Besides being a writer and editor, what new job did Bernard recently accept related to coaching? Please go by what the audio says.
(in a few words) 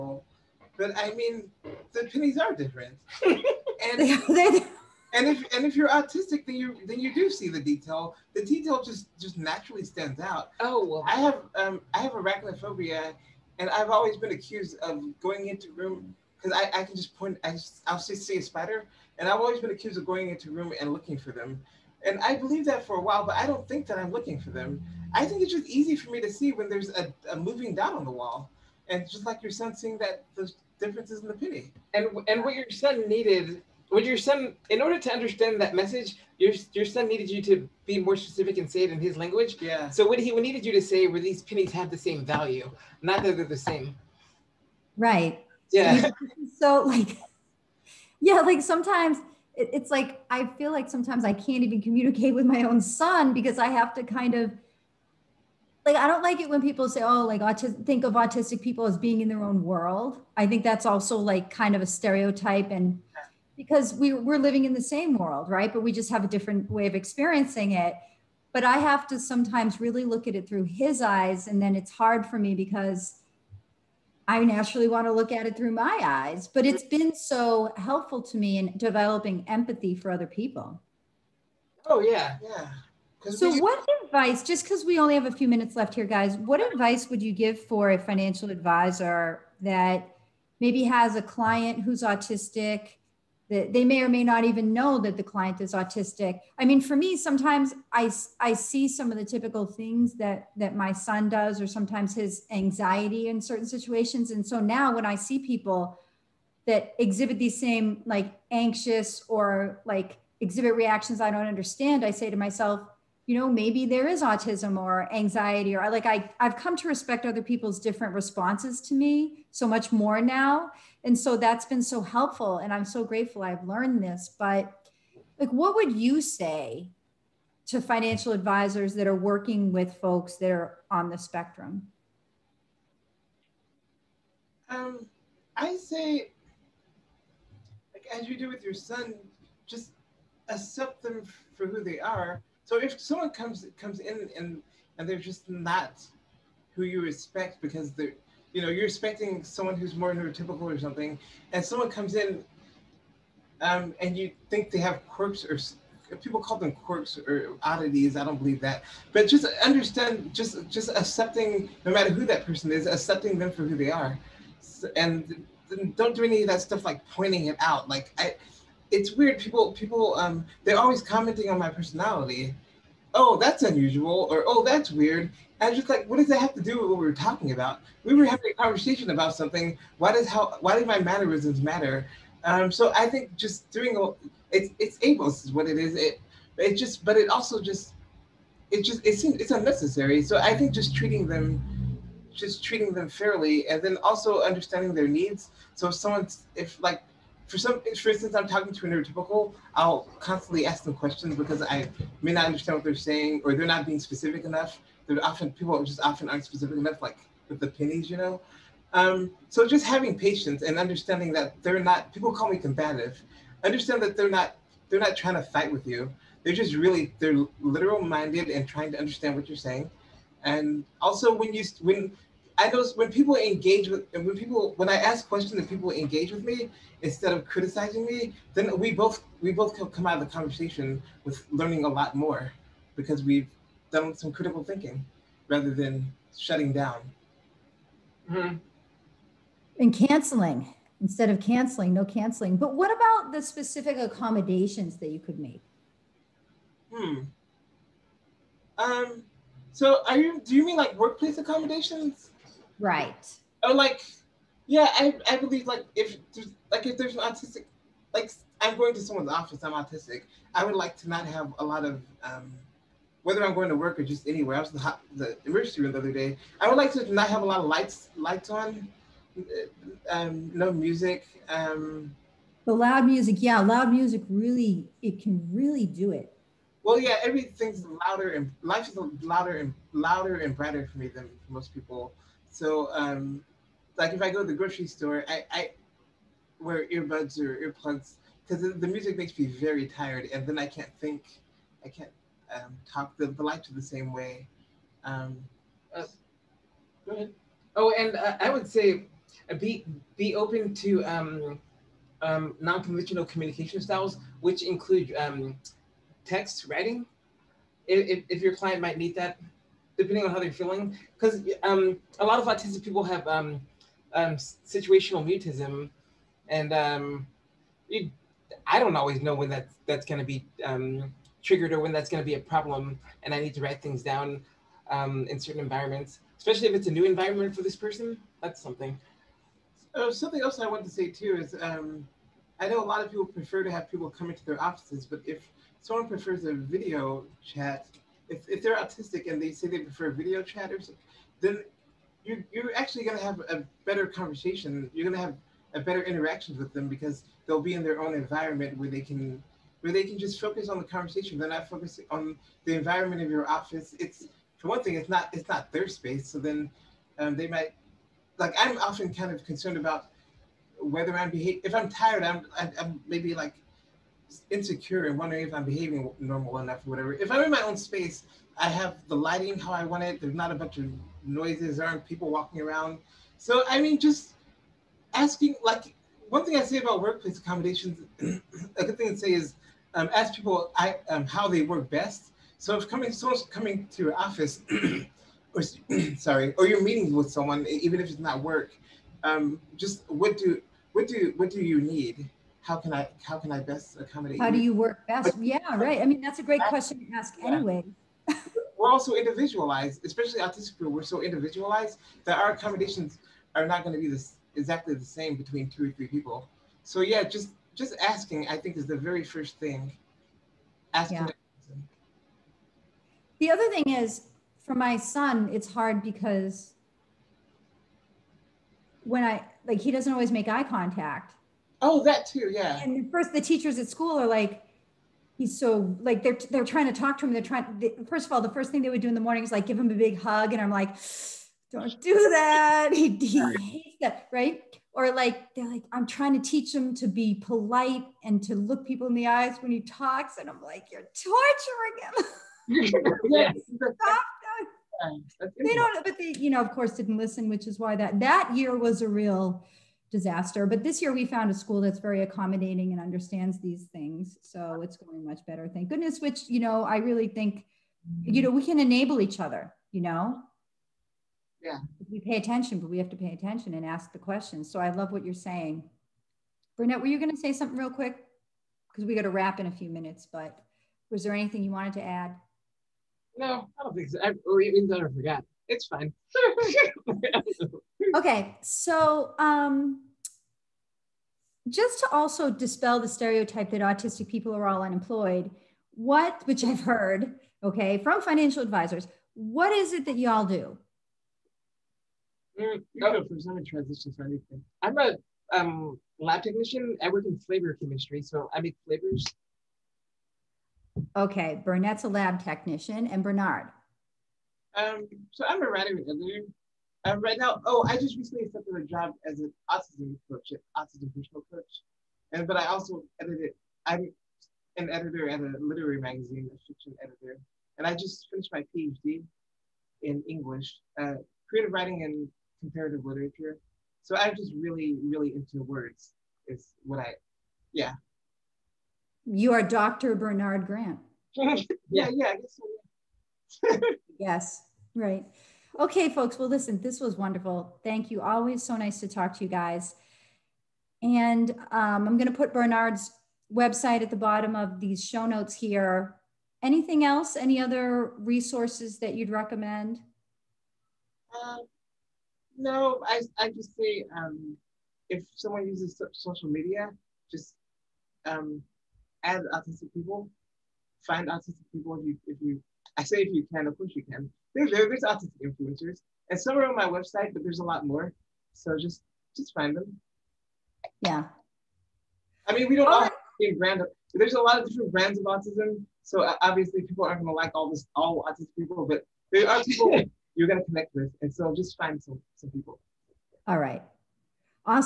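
autism coach.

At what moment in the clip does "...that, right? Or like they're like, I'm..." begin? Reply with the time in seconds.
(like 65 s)
434 s.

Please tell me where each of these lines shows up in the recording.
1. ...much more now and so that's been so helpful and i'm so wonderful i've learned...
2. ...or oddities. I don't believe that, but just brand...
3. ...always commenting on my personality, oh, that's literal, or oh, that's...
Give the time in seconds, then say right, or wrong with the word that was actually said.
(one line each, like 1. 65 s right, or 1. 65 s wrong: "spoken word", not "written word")
1. 119 s wrong: "grateful", not "wonderful"
2. 157 s wrong: "understand", not "brand"
3. 170 s wrong: "unusual", not "literal".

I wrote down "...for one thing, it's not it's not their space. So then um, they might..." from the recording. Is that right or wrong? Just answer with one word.
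right.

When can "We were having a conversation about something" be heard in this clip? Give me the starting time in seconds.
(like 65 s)
178 s.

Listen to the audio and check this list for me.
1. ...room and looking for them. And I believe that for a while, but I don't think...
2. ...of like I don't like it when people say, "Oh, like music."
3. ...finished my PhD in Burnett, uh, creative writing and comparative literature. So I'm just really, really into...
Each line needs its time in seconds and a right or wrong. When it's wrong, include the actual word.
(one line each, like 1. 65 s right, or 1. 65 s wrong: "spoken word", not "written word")
1. 20 s right
2. 54 s wrong: "autistic", not "music"
3. 518 s wrong: "English", not "Burnett".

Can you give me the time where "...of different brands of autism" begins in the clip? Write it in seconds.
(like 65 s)
574 s.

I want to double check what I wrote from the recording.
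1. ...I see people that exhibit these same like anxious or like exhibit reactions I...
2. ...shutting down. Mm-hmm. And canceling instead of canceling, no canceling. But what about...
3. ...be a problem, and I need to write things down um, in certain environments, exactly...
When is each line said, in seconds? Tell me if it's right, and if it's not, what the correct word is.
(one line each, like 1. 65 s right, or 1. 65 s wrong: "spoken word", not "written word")
1. 105 s right
2. 236 s right
3. 322 s wrong: "especially", not "exactly".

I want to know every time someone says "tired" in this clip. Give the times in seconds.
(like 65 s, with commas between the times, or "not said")
289 s, 361 s.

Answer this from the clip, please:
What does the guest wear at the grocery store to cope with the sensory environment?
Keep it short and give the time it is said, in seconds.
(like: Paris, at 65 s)
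earbuds or earplugs, at 286 s.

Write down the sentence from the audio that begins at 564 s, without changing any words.
There's, there's autistic influencers, and some are on my website, but there's a lot more.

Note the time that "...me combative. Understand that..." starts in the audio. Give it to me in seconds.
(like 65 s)
212 s.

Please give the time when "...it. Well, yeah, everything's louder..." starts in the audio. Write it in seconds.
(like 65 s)
276 s.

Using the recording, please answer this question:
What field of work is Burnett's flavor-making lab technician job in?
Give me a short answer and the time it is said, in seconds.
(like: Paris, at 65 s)
flavor chemistry, at 497 s.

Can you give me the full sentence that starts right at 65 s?
But we just have a different way of experiencing it.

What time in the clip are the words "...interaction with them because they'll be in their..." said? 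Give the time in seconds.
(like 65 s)
346 s.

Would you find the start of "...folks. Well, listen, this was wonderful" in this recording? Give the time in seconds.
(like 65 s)
536 s.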